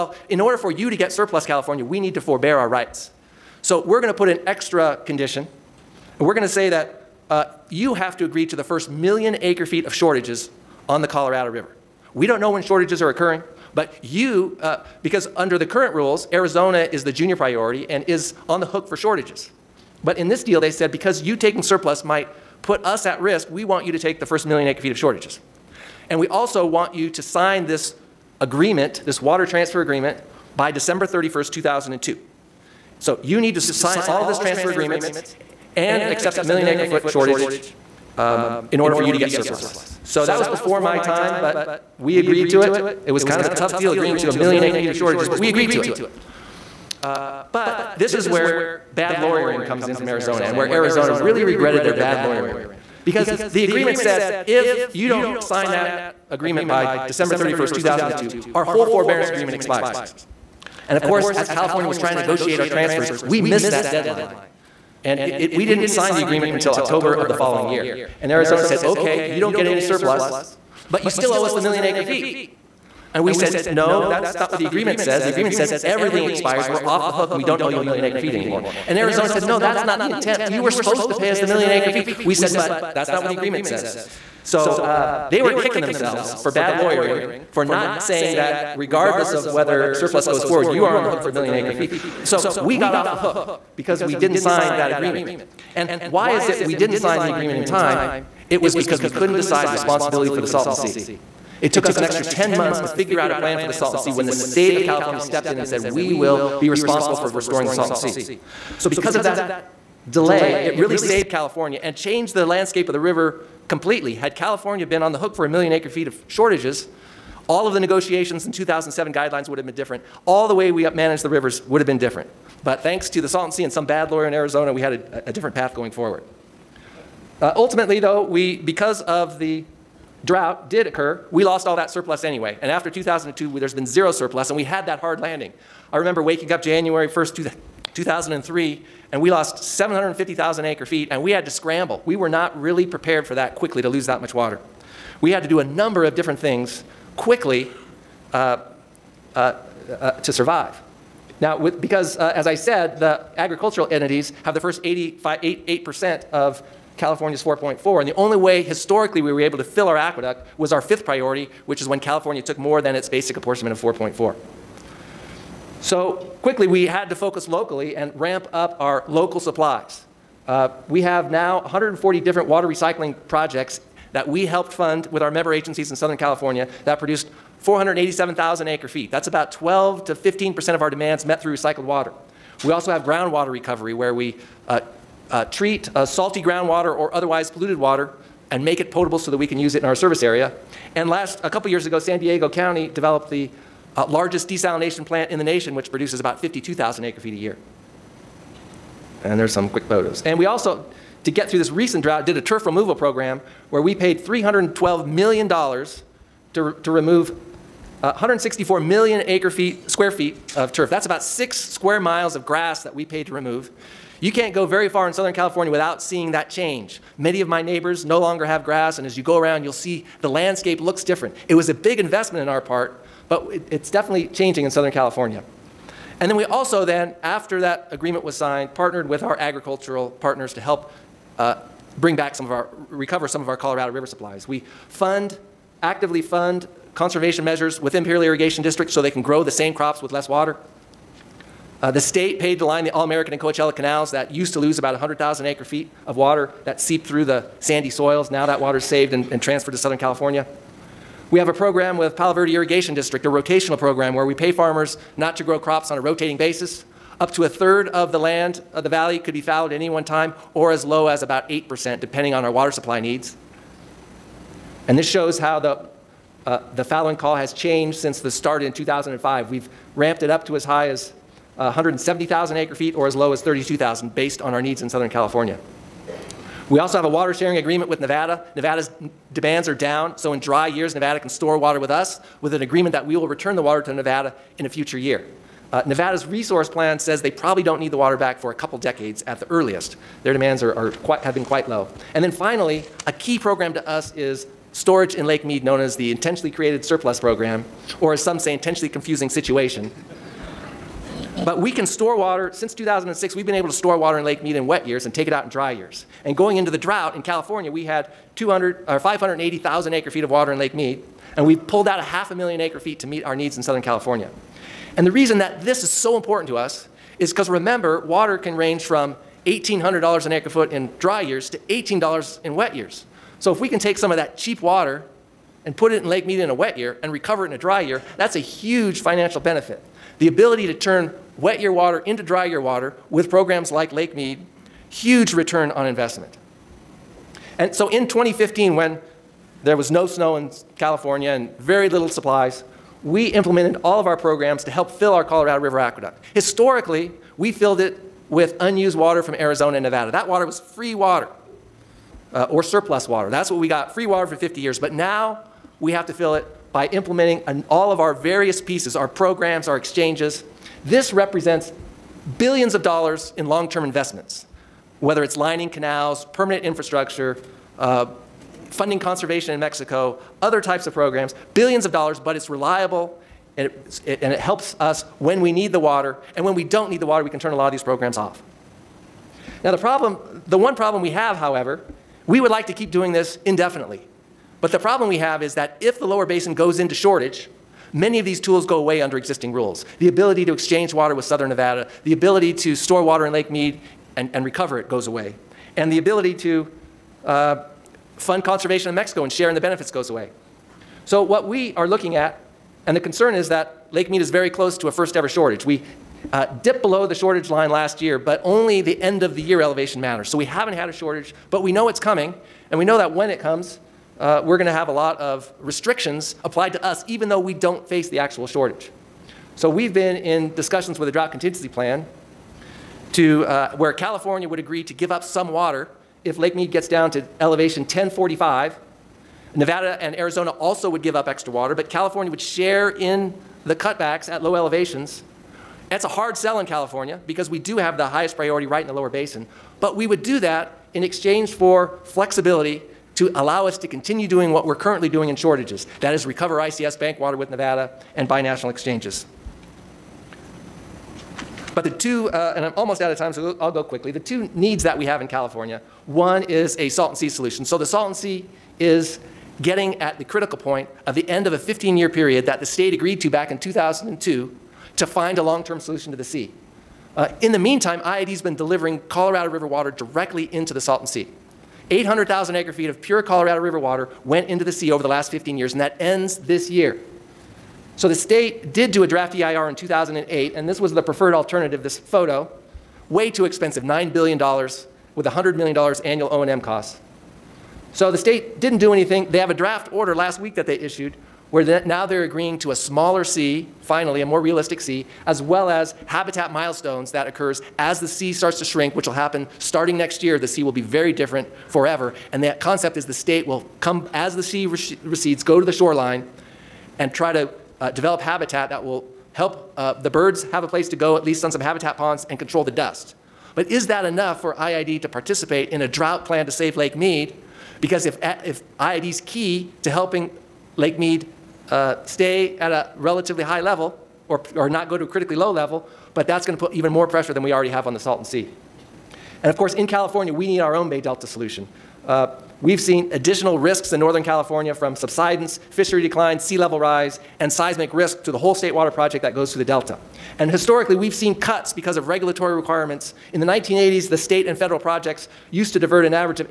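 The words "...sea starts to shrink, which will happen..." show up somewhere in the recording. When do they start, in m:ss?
8:18.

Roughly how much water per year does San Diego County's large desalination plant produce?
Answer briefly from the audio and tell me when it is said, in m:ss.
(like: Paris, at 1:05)
52,000 acre feet, at 3:16.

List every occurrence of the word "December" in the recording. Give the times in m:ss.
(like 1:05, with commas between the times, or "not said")
0:30, 0:57.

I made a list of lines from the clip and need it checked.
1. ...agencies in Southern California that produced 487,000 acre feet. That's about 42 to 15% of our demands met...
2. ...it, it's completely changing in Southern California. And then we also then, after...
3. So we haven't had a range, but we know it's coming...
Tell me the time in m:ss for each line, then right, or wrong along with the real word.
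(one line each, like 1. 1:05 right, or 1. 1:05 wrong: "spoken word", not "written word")
1. 2:55 wrong: "12", not "42"
2. 3:43 wrong: "definitely", not "completely"
3. 6:50 wrong: "shortage", not "range".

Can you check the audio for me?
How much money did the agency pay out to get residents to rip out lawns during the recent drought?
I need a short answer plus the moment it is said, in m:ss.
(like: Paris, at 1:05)
$312 million, at 3:24.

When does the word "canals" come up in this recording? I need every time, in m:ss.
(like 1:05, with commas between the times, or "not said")
4:03, 6:05.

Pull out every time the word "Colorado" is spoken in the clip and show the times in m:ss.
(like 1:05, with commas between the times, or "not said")
0:11, 3:53, 5:45, 7:49, 7:53.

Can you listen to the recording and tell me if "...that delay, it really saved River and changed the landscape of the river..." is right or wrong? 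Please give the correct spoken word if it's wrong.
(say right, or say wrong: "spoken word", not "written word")
wrong: "California", not "River".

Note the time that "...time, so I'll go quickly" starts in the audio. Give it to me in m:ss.
7:33.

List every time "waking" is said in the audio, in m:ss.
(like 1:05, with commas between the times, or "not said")
2:16.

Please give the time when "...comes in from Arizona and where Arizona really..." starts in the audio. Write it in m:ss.
0:49.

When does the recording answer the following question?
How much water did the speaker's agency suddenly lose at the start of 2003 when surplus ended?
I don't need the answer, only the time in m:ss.
2:19.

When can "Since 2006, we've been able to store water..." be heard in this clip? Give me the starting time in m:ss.
5:02.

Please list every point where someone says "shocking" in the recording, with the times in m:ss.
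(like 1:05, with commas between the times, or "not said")
not said.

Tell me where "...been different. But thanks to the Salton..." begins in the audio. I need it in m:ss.
2:01.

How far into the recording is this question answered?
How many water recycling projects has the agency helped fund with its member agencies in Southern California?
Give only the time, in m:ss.
2:51.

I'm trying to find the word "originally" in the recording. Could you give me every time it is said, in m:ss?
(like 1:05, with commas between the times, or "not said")
not said.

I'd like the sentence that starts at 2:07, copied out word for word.
Uh, ultimately, though, we, because of the drought did occur, we lost all that surplus anyway.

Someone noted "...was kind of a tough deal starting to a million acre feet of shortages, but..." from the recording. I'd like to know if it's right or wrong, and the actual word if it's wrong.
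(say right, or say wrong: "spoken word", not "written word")
wrong: "agreeing", not "starting".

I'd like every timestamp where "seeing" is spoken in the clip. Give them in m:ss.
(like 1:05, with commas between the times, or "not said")
3:36.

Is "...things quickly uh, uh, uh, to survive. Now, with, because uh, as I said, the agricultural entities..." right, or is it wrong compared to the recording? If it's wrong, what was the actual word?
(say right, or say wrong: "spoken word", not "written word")
right.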